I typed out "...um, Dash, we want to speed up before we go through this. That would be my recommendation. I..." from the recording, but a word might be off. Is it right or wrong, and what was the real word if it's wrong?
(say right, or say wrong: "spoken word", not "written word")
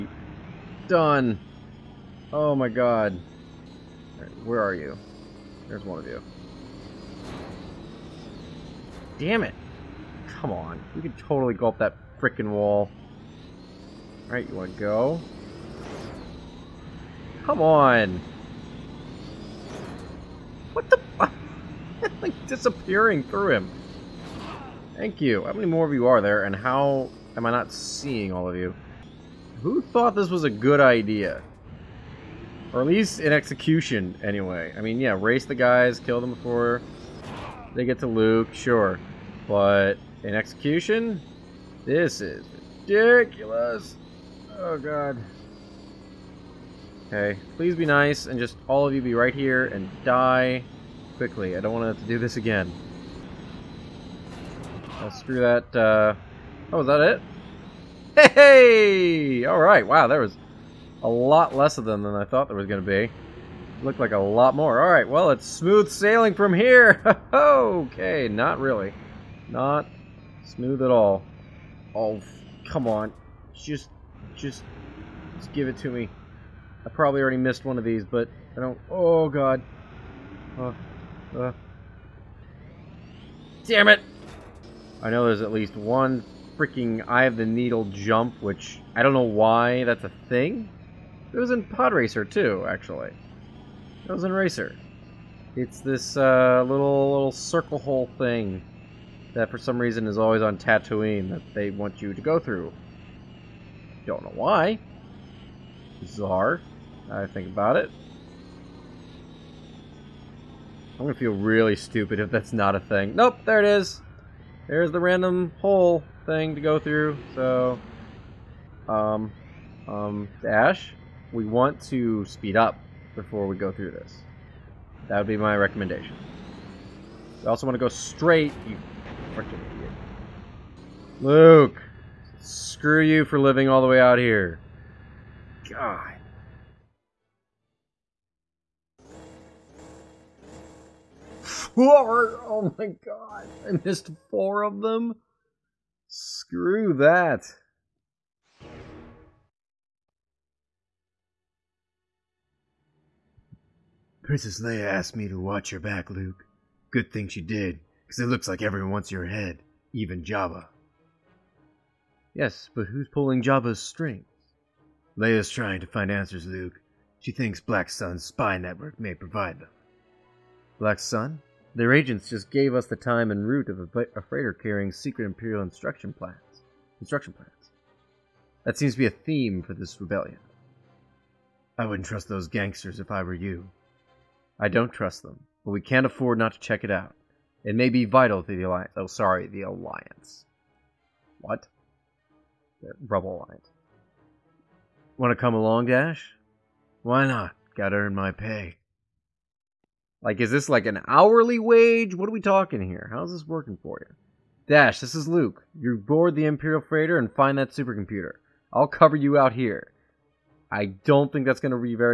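right.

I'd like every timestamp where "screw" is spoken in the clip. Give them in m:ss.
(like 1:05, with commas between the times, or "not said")
0:55, 2:12, 2:26.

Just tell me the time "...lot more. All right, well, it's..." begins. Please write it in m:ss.
1:04.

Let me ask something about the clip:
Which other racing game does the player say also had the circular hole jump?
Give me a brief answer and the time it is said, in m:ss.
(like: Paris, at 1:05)
Pod Racer, at 1:31.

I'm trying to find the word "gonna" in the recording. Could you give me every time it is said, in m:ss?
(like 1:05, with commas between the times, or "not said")
1:51.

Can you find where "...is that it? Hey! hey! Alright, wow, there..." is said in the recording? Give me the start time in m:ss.
0:56.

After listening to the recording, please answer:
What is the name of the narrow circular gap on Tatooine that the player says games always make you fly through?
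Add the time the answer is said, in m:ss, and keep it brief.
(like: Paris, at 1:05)
Eye of the Needle, at 1:27.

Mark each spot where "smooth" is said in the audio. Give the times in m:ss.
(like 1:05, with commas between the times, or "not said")
1:05, 1:10.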